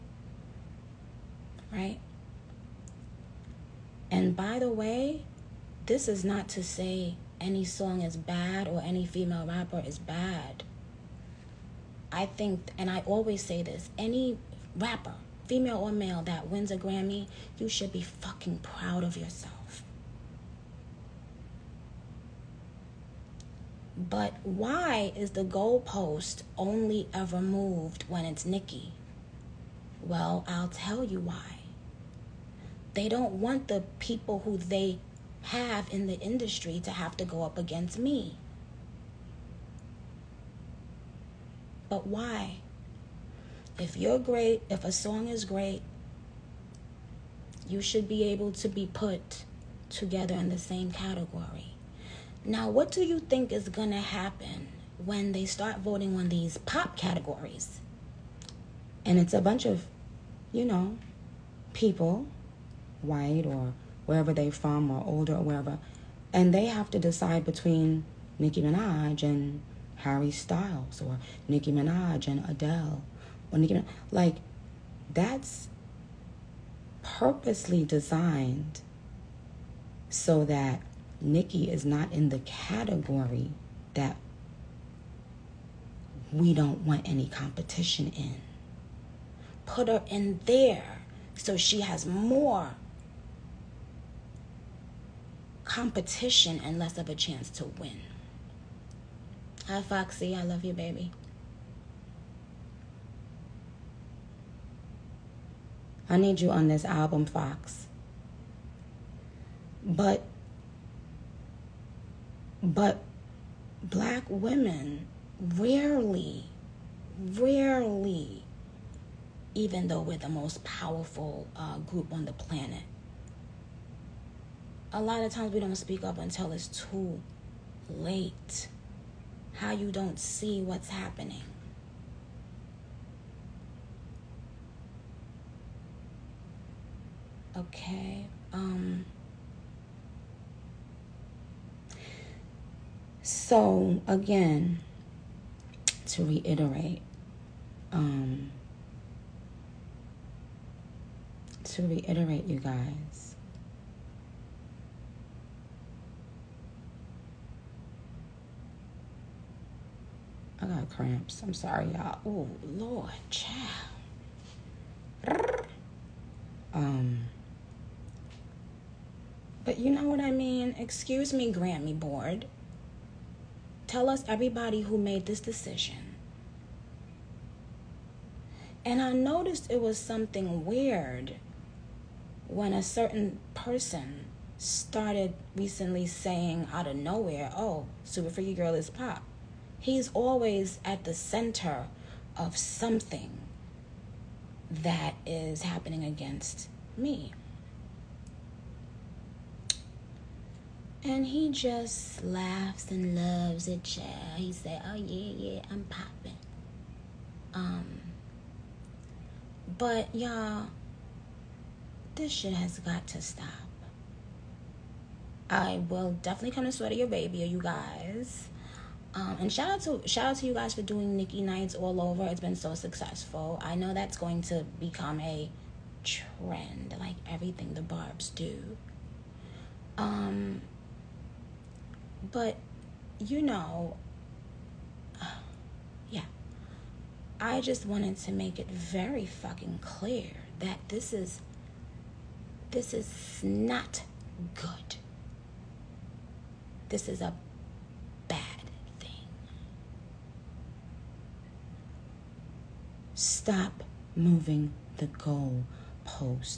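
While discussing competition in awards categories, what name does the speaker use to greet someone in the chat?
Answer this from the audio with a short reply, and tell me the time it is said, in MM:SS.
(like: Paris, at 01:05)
Foxy, at 01:39.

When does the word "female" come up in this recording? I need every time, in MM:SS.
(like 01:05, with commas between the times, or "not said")
00:09, 00:15.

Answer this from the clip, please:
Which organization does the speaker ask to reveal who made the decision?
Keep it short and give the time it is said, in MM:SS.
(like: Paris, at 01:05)
Grammy Board, at 02:51.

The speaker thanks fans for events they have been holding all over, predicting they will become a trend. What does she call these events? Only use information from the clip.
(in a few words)
Nicki nights.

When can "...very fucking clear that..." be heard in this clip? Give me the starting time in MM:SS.
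03:58.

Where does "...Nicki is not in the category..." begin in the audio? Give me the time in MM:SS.
01:21.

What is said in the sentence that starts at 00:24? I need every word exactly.
But why is the goalpost only ever moved when it's Nicki?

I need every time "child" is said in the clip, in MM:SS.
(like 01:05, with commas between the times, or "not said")
02:43, 03:23.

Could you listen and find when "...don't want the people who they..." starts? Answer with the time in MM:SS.
00:33.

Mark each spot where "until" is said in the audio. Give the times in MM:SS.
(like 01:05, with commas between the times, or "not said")
02:06.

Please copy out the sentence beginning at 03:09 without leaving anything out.
He's always at the center of something that is happening against me.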